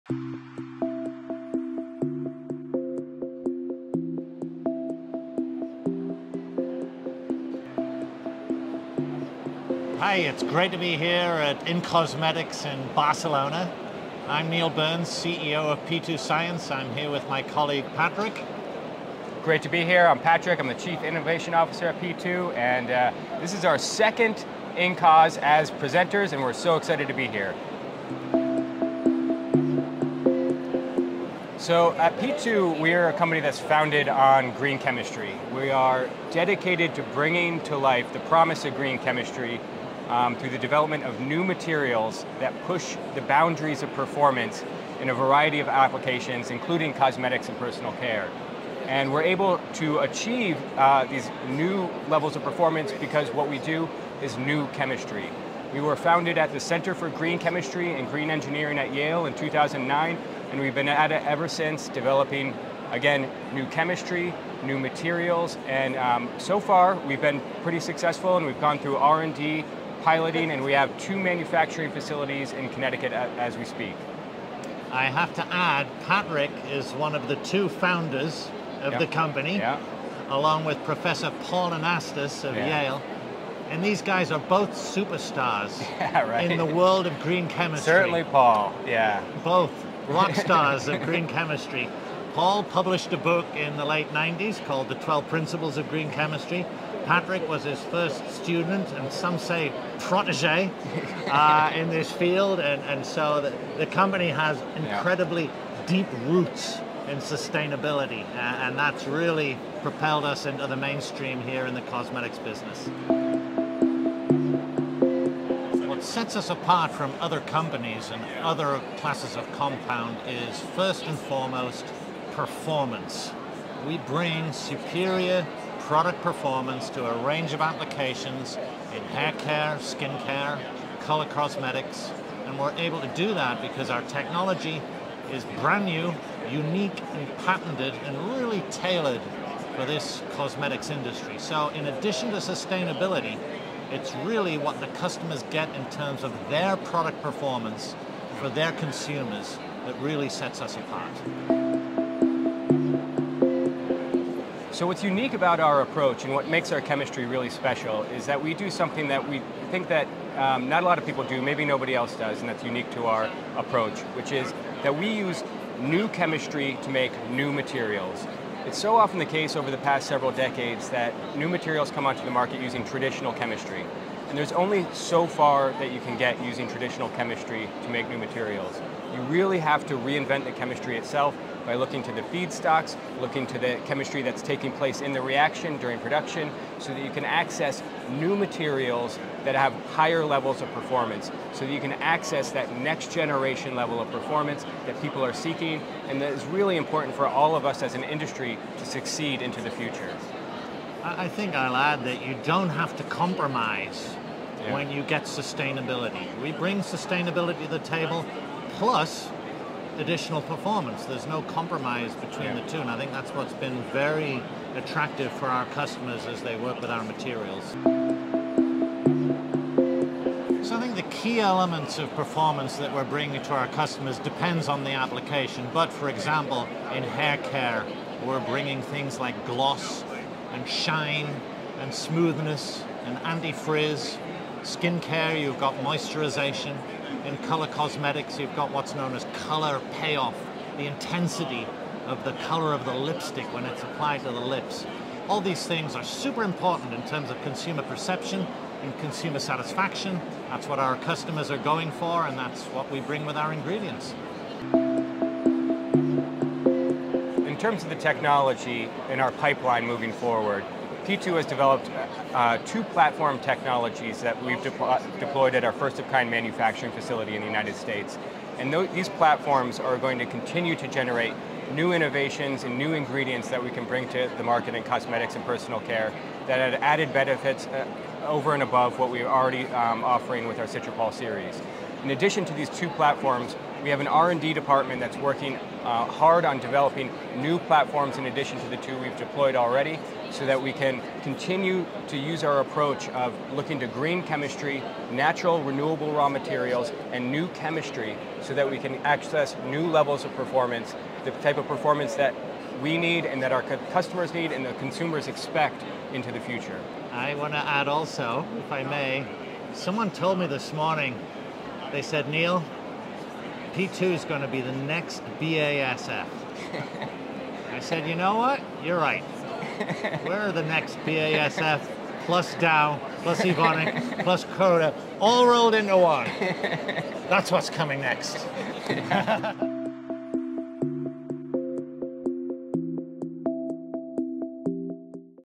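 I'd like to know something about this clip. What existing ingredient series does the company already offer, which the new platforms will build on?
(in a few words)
Citropol.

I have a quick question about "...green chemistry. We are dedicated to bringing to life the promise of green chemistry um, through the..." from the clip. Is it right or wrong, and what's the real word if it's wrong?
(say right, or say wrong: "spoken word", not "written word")
right.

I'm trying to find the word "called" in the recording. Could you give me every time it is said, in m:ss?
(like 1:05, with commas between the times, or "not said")
1:34.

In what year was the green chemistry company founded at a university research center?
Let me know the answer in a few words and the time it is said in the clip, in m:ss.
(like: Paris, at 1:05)
2009, at 0:59.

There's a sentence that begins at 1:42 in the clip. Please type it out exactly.
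And, and so the, the company has incredibly yeah.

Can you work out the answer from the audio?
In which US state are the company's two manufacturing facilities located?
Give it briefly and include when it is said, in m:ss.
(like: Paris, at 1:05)
Connecticut, at 1:12.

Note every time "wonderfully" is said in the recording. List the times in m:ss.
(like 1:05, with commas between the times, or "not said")
not said.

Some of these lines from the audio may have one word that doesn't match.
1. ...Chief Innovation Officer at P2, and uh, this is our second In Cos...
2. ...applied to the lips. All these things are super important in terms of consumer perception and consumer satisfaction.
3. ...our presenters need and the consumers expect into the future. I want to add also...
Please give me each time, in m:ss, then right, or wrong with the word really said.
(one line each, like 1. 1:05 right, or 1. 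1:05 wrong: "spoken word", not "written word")
1. 0:20 right
2. 4:03 right
3. 5:03 wrong: "customers", not "presenters".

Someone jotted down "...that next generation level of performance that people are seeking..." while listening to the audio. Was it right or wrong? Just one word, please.
right.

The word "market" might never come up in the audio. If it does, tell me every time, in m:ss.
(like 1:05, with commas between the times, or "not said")
2:52, 4:34.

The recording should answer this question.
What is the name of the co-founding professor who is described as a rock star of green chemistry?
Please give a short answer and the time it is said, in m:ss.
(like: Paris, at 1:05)
Paul Anastas, at 1:21.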